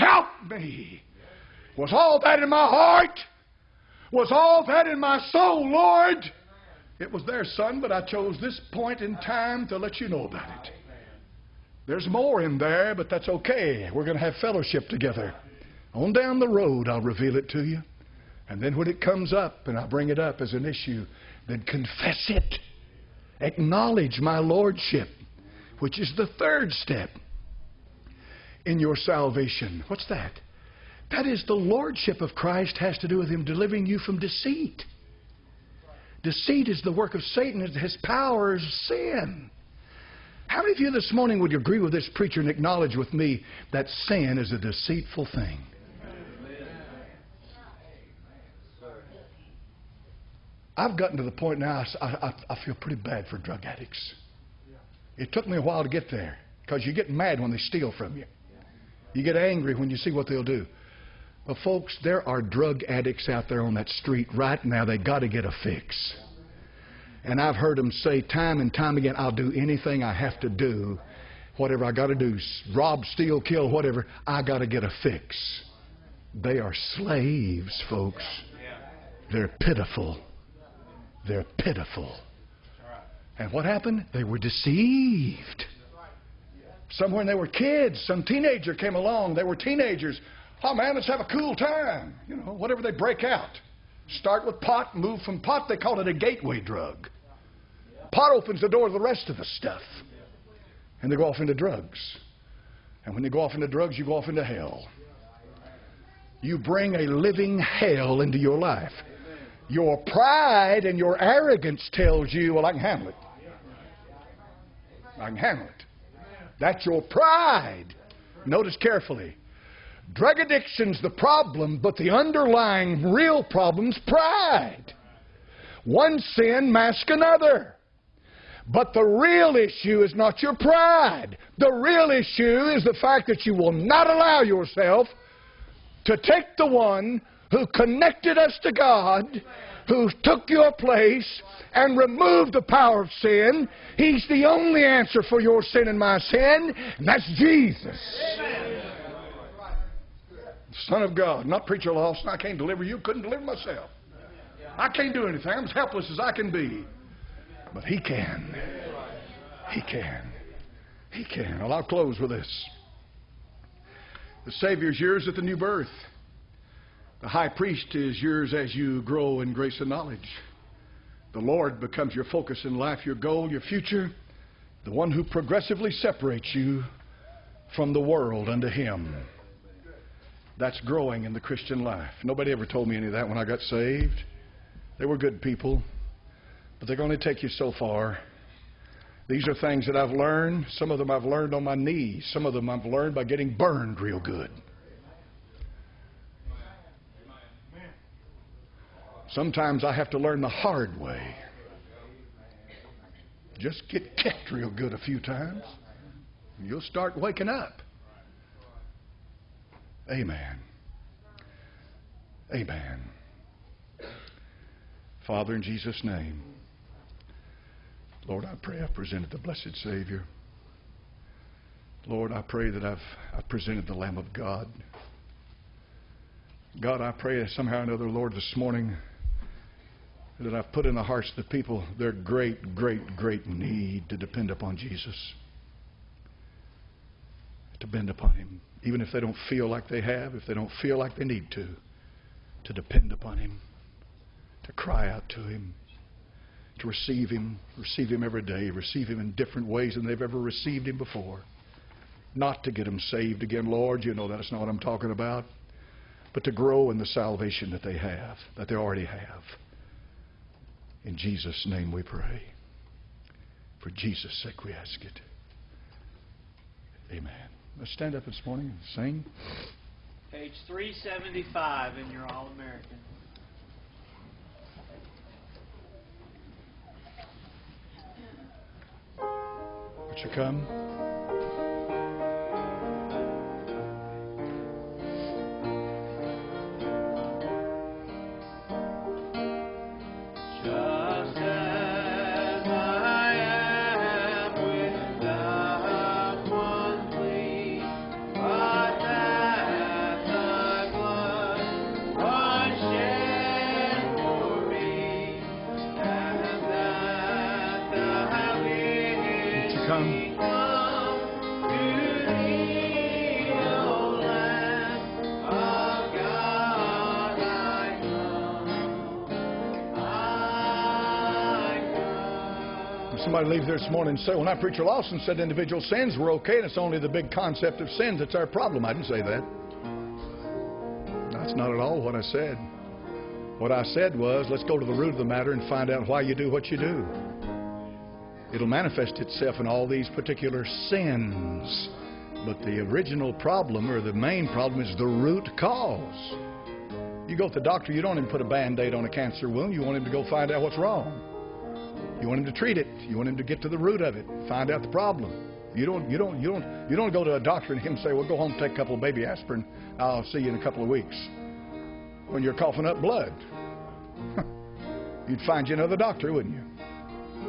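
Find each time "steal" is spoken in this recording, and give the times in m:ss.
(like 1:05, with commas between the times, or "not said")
0:57, 1:13.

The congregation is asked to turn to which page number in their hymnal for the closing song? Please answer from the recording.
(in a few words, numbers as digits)
375.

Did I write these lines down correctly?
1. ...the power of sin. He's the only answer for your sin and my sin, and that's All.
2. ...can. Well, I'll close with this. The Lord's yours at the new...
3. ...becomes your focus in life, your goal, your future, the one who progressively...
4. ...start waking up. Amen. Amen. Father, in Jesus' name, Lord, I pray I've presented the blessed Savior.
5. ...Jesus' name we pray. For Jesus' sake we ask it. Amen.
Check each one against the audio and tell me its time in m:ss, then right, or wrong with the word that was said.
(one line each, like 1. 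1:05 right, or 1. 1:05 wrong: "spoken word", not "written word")
1. 2:22 wrong: "Jesus", not "All"
2. 2:41 wrong: "Savior", not "Lord"
3. 2:51 right
4. 3:26 right
5. 4:21 right.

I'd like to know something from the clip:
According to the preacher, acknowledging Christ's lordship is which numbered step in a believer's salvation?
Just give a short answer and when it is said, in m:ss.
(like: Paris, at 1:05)
third, at 0:26.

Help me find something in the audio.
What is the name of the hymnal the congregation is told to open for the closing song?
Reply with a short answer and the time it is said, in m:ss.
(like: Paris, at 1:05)
All American, at 4:32.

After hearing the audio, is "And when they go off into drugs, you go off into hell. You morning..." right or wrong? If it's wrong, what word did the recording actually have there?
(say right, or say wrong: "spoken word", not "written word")
wrong: "bring", not "morning".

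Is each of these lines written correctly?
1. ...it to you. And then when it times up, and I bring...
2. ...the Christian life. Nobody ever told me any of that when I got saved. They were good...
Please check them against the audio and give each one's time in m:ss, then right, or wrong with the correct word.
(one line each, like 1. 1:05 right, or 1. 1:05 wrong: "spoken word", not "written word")
1. 0:17 wrong: "comes", not "times"
2. 3:01 right.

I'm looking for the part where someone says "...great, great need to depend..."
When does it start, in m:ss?
3:52.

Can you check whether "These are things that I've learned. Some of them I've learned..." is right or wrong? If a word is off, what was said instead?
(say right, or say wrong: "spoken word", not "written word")
right.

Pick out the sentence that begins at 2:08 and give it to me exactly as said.
But the real issue is not your pride.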